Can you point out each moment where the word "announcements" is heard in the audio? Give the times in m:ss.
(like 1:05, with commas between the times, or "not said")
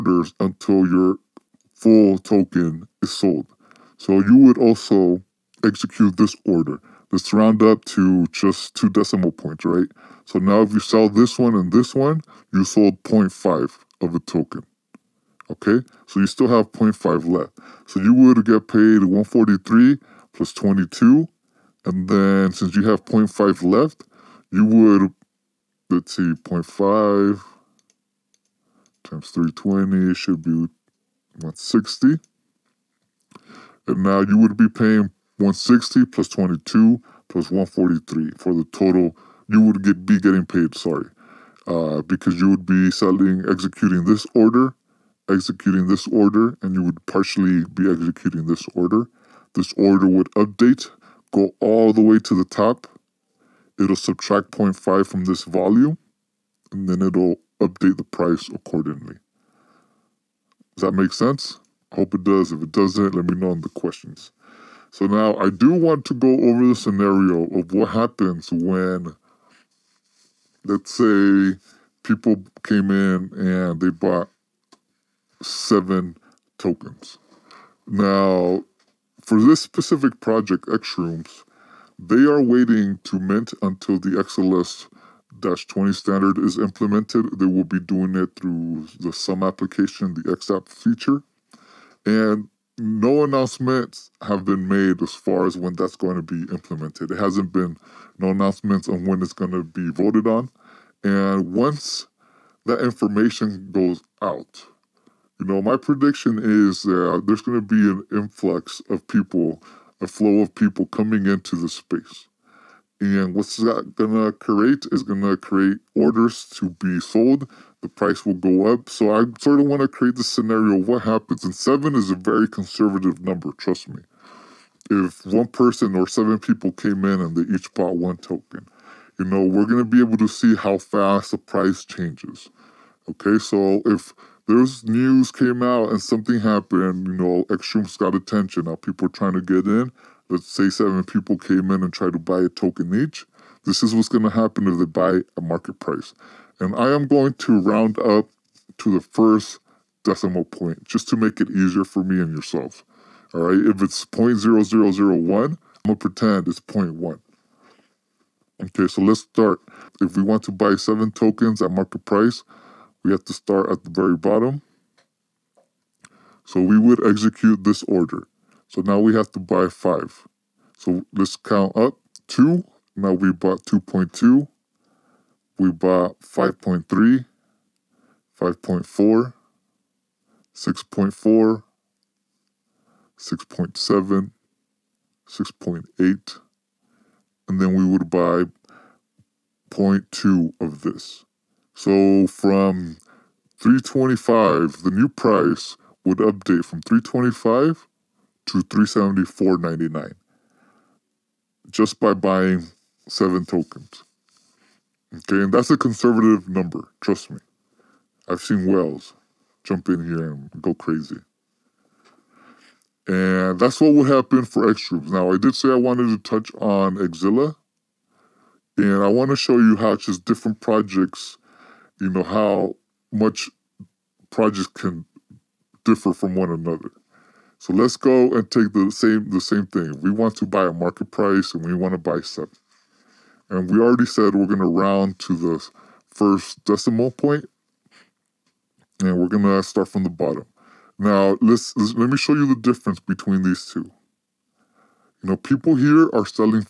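1:33, 1:38.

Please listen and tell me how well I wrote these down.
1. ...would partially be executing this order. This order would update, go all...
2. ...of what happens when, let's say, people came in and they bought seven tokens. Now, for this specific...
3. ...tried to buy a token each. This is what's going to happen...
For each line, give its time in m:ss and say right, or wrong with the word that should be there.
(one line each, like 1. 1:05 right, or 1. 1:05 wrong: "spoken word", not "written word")
1. 0:46 right
2. 1:07 right
3. 2:21 right.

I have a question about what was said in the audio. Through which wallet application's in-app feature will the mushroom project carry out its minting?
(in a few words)
Xumm.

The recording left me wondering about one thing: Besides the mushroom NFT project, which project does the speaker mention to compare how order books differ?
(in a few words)
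xZilla.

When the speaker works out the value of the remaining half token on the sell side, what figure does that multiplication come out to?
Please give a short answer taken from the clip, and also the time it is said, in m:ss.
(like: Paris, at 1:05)
160, at 0:30.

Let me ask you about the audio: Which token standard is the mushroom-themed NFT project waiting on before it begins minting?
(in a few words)
XLS-20.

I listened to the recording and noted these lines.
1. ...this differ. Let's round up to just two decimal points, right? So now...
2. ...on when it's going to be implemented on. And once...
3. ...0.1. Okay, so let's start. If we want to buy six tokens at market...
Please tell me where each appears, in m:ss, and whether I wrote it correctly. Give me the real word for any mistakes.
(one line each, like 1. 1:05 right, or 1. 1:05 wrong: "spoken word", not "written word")
1. 0:06 wrong: "order", not "differ"
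2. 1:38 wrong: "voted", not "implemented"
3. 2:36 wrong: "seven", not "six".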